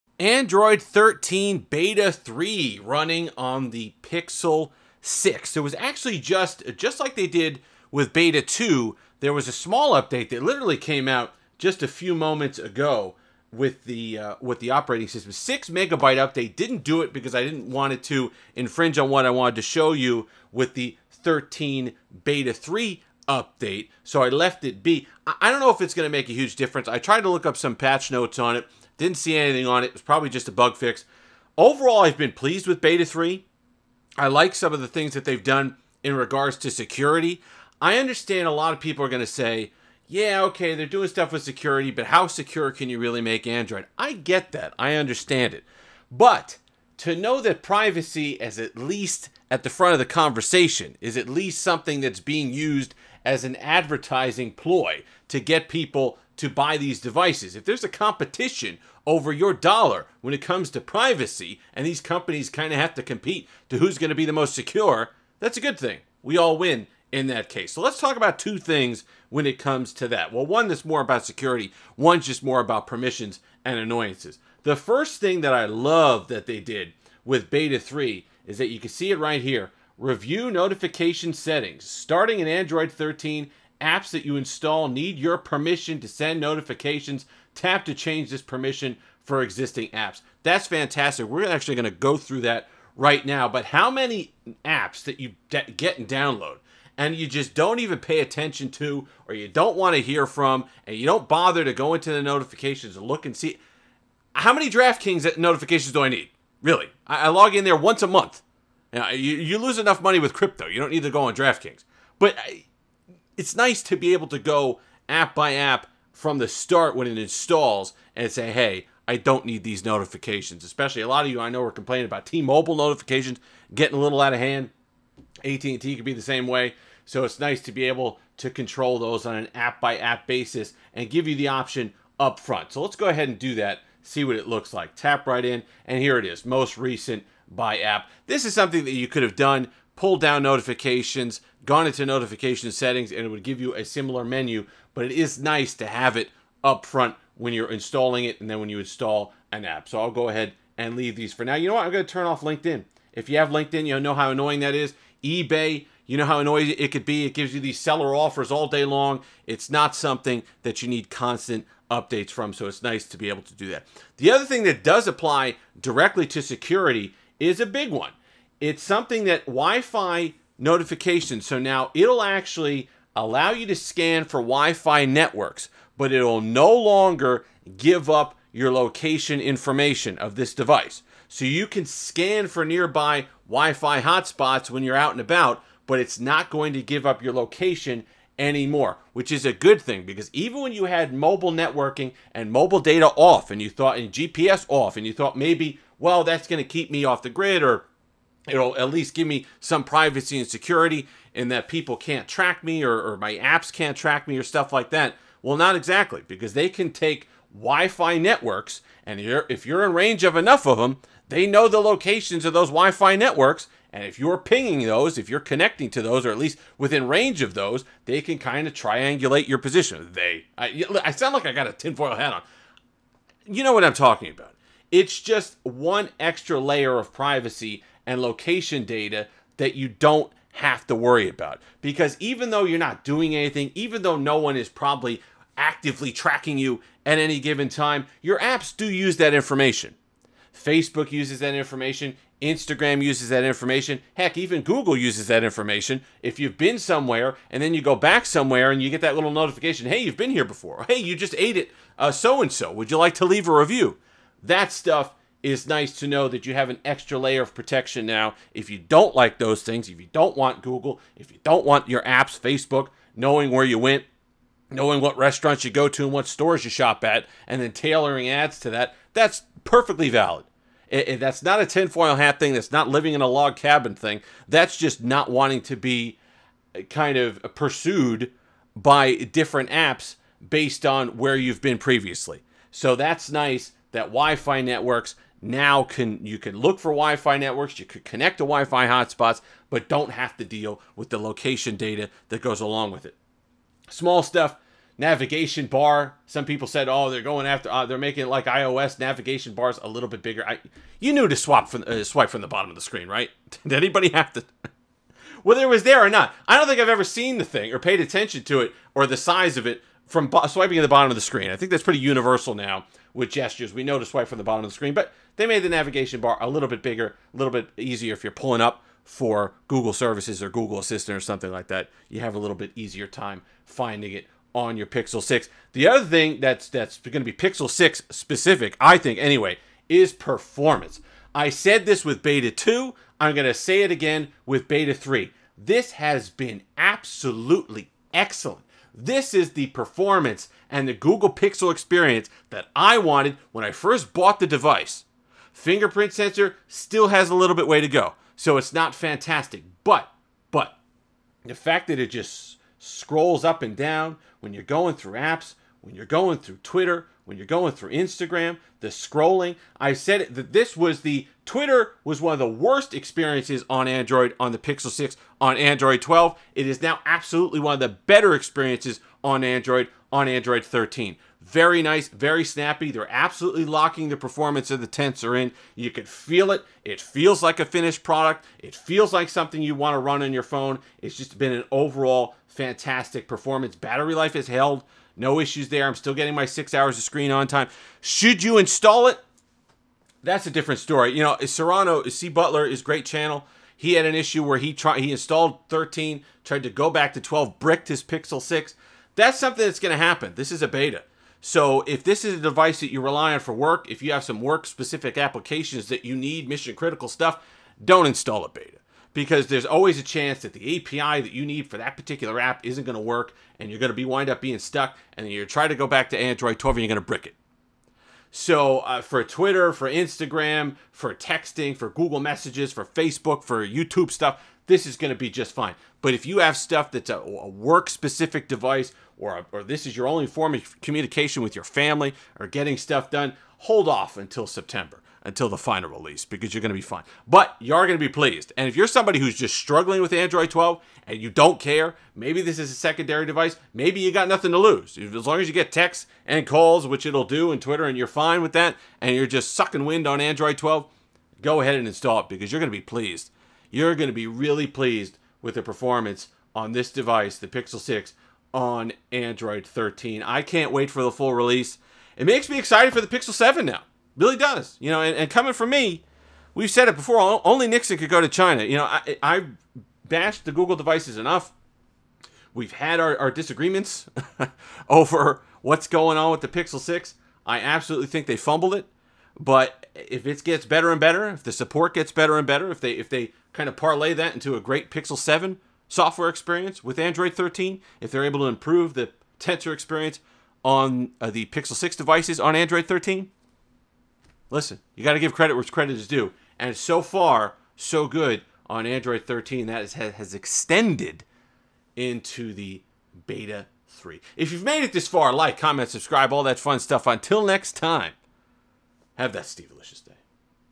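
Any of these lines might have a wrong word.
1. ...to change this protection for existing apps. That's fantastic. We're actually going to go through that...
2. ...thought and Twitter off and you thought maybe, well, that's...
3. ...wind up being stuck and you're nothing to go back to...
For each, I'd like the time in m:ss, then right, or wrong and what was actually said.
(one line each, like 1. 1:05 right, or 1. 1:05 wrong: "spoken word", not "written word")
1. 1:27 wrong: "permission", not "protection"
2. 3:13 wrong: "GPS", not "Twitter"
3. 6:54 wrong: "trying", not "nothing".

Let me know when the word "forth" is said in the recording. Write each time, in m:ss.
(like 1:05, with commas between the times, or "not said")
not said.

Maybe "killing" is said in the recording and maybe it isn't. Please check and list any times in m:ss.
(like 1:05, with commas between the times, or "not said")
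not said.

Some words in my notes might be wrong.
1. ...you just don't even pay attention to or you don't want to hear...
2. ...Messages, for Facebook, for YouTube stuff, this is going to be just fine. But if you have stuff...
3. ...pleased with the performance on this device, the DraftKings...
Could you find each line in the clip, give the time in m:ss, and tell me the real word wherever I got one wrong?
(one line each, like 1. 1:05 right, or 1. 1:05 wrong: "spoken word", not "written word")
1. 1:37 right
2. 7:02 right
3. 7:34 wrong: "Pixel", not "DraftKings".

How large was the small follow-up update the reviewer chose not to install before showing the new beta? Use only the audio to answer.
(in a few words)
6 megabytes.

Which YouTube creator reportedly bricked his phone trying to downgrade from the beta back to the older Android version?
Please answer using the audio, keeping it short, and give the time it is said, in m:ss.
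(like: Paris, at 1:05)
C. Butler, at 6:32.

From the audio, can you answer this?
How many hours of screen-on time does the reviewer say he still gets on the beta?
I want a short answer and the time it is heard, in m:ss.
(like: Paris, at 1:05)
6 hours, at 6:26.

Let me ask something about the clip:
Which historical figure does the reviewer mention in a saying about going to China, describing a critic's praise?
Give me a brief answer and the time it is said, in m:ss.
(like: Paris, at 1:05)
Nixon, at 7:47.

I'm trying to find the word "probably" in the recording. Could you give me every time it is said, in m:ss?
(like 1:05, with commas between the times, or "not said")
0:30, 3:54.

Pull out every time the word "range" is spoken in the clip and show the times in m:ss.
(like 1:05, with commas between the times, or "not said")
3:29, 3:37.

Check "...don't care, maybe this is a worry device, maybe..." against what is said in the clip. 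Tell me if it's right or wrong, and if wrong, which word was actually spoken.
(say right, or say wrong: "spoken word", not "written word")
wrong: "secondary", not "worry".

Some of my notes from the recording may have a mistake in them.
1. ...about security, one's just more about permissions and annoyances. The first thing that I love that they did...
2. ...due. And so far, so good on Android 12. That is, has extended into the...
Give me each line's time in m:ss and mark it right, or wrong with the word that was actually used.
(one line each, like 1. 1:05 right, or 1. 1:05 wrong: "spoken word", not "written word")
1. 1:11 right
2. 8:16 wrong: "13", not "12".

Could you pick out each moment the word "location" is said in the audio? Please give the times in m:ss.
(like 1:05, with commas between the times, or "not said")
2:58, 3:07, 3:31, 3:48, 4:51.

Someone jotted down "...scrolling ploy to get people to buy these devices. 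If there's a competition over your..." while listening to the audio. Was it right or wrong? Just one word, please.
wrong.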